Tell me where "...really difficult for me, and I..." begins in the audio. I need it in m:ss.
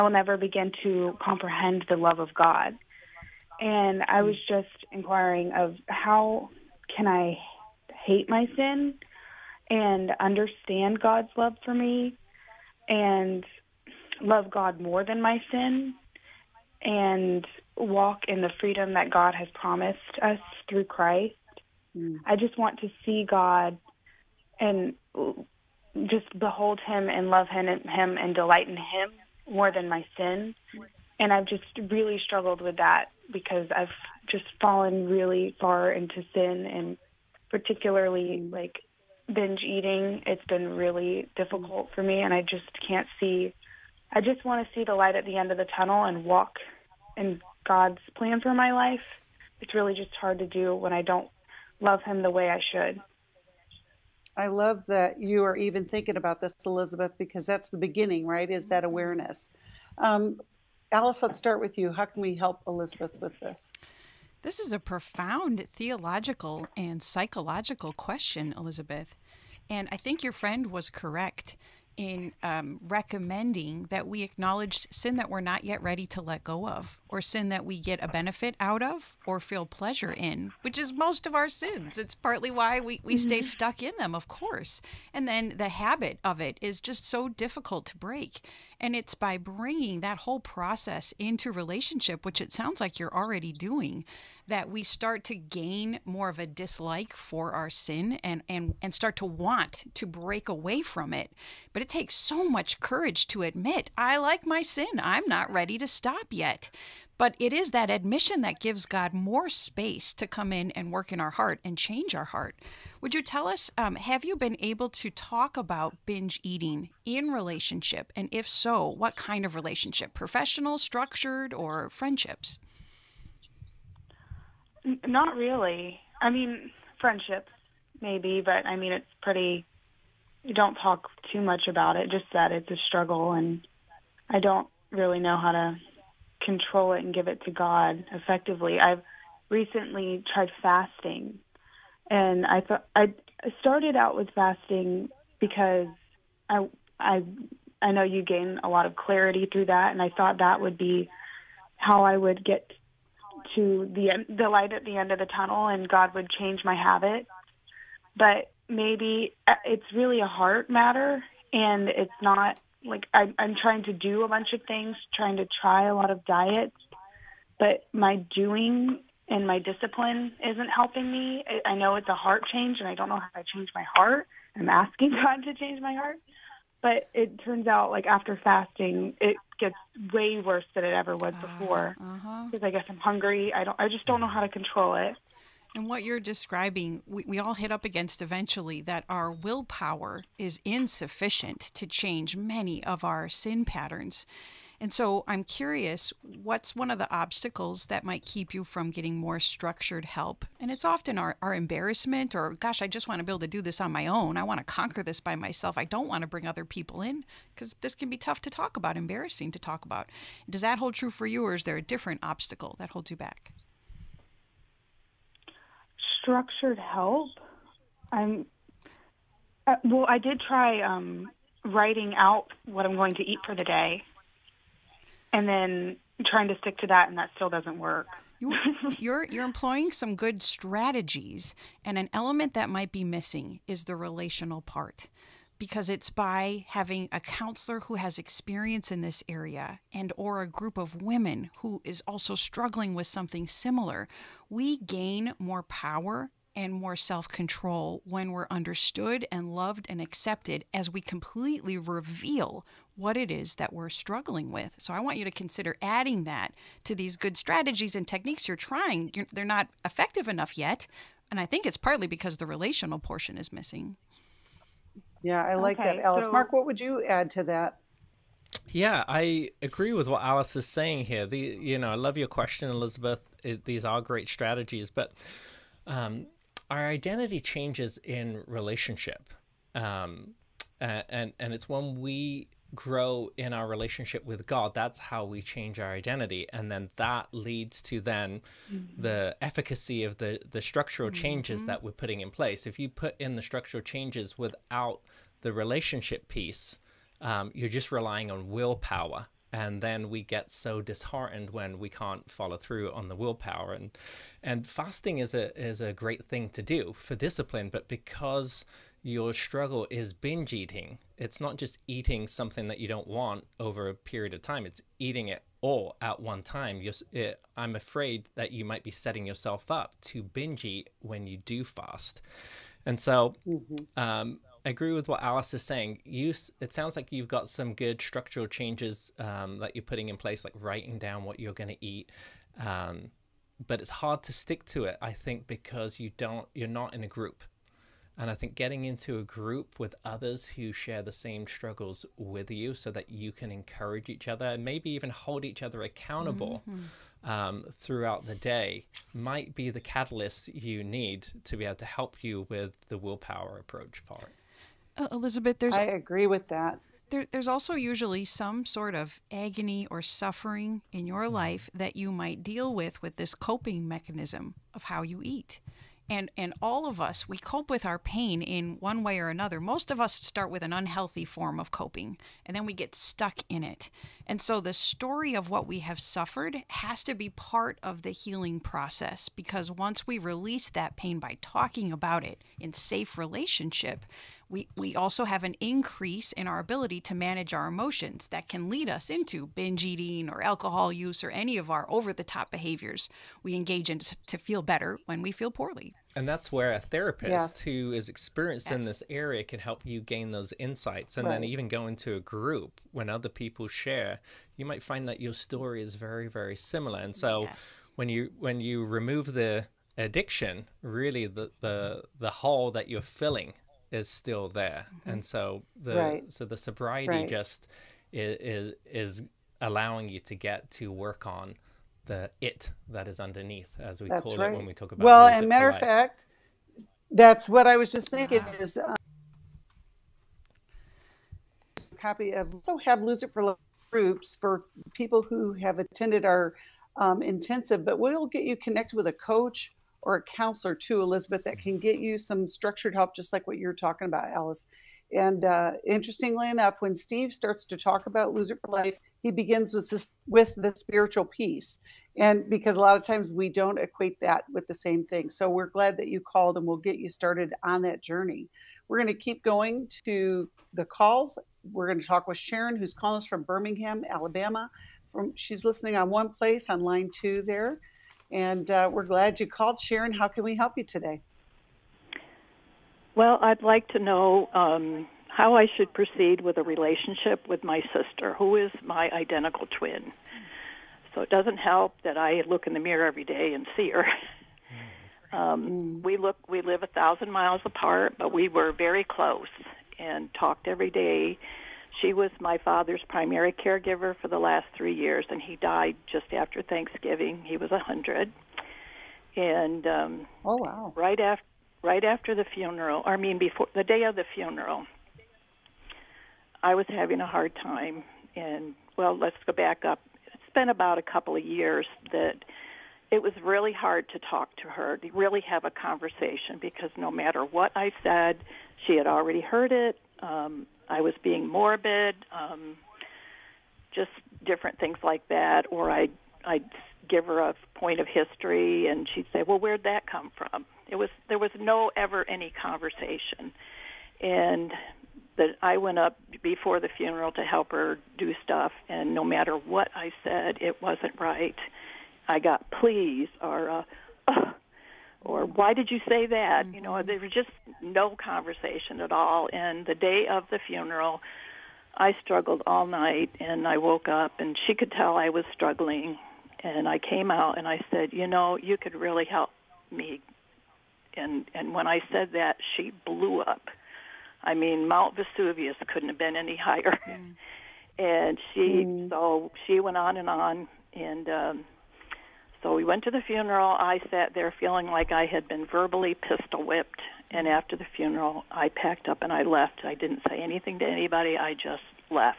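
0:40.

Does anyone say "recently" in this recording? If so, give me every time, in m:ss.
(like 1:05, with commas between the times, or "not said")
2:19.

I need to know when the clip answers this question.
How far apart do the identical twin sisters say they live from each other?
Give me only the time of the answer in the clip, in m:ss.
8:06.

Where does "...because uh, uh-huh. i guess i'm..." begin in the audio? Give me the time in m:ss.
3:01.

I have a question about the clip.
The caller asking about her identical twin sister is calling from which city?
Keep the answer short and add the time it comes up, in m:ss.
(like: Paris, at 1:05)
Birmingham, Alabama, at 7:43.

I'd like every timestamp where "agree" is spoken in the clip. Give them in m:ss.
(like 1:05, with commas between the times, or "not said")
4:29, 5:24, 5:55.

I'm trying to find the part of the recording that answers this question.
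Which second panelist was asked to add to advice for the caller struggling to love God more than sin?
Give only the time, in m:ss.
4:26.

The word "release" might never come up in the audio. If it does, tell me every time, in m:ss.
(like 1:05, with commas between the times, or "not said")
6:20.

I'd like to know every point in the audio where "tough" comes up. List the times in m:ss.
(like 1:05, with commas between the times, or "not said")
3:28.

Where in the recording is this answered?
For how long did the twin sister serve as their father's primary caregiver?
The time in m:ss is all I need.
8:14.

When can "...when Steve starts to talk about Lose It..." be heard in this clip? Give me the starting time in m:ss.
7:26.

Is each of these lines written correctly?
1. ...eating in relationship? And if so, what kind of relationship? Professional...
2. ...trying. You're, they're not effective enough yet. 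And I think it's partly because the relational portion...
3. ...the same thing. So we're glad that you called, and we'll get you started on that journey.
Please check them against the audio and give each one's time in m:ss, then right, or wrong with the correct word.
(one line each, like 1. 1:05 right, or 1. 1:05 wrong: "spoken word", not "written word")
1. 1:56 right
2. 4:18 right
3. 7:34 right.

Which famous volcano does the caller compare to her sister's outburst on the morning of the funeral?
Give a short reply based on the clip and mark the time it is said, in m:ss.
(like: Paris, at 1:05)
Mount Vesuvius, at 9:24.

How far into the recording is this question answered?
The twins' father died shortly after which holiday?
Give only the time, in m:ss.
8:16.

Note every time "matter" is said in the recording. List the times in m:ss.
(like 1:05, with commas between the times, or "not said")
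2:40, 7:05, 8:37, 8:59.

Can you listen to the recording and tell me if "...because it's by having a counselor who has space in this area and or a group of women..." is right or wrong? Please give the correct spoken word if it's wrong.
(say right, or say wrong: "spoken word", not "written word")
wrong: "experience", not "space".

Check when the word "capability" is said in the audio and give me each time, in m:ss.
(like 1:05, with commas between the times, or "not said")
not said.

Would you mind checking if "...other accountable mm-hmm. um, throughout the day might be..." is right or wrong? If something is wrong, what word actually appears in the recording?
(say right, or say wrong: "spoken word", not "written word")
right.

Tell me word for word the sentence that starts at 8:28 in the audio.
And well, let's go back up.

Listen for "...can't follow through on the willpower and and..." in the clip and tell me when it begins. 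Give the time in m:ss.
5:02.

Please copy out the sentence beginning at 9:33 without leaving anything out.
I sat there feeling like I had been verbally pistol whipped.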